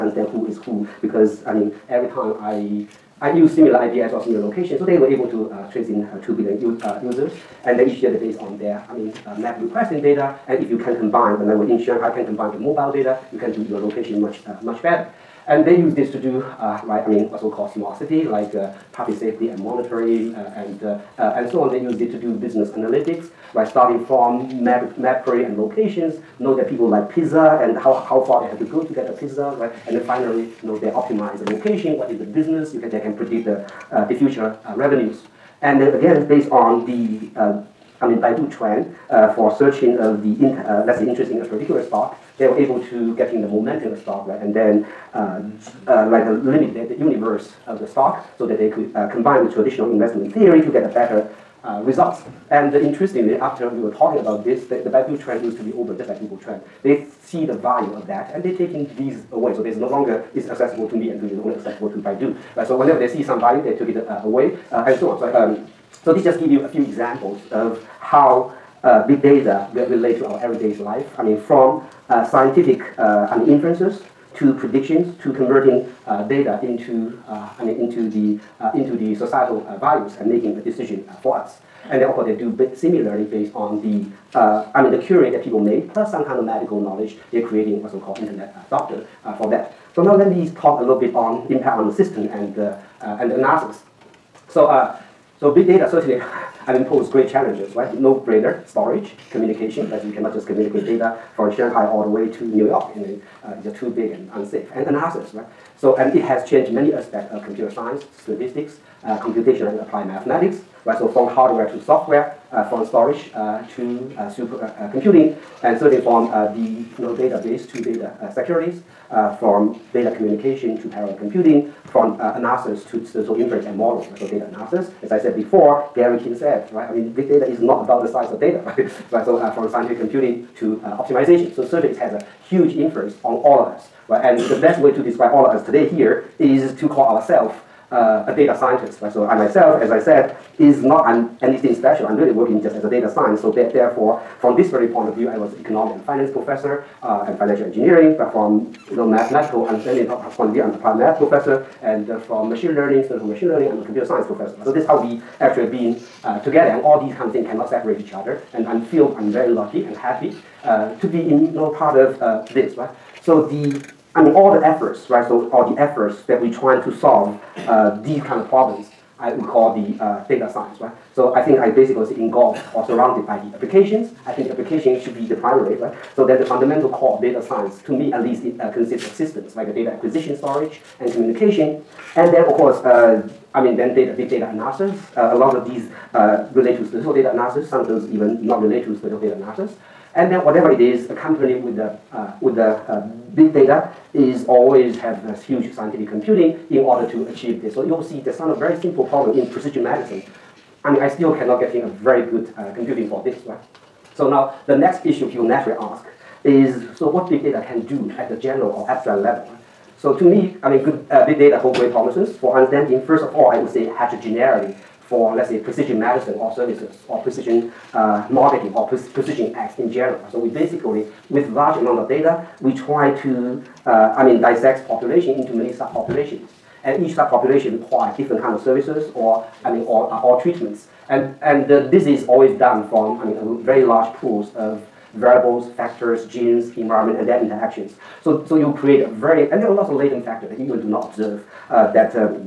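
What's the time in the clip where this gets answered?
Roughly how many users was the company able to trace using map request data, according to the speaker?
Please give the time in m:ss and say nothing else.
0:06.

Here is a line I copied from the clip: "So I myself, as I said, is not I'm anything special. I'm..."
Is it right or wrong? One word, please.
right.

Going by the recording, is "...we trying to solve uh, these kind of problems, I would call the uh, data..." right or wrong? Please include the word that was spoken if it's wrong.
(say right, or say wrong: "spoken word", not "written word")
right.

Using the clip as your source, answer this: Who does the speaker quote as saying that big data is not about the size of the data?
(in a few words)
Gary King.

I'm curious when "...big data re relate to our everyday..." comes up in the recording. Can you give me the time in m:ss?
1:09.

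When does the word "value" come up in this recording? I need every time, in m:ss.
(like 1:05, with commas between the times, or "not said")
0:57, 1:03, 1:19.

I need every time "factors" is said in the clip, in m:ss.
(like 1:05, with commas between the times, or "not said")
3:55, 4:00.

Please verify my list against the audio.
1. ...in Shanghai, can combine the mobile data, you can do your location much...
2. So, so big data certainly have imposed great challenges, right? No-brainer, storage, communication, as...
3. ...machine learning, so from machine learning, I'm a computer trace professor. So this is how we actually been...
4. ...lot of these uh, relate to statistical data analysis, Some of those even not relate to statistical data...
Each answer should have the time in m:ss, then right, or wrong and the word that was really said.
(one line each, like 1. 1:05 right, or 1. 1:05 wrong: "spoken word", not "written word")
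1. 0:11 right
2. 1:34 right
3. 2:32 wrong: "science", not "trace"
4. 3:05 right.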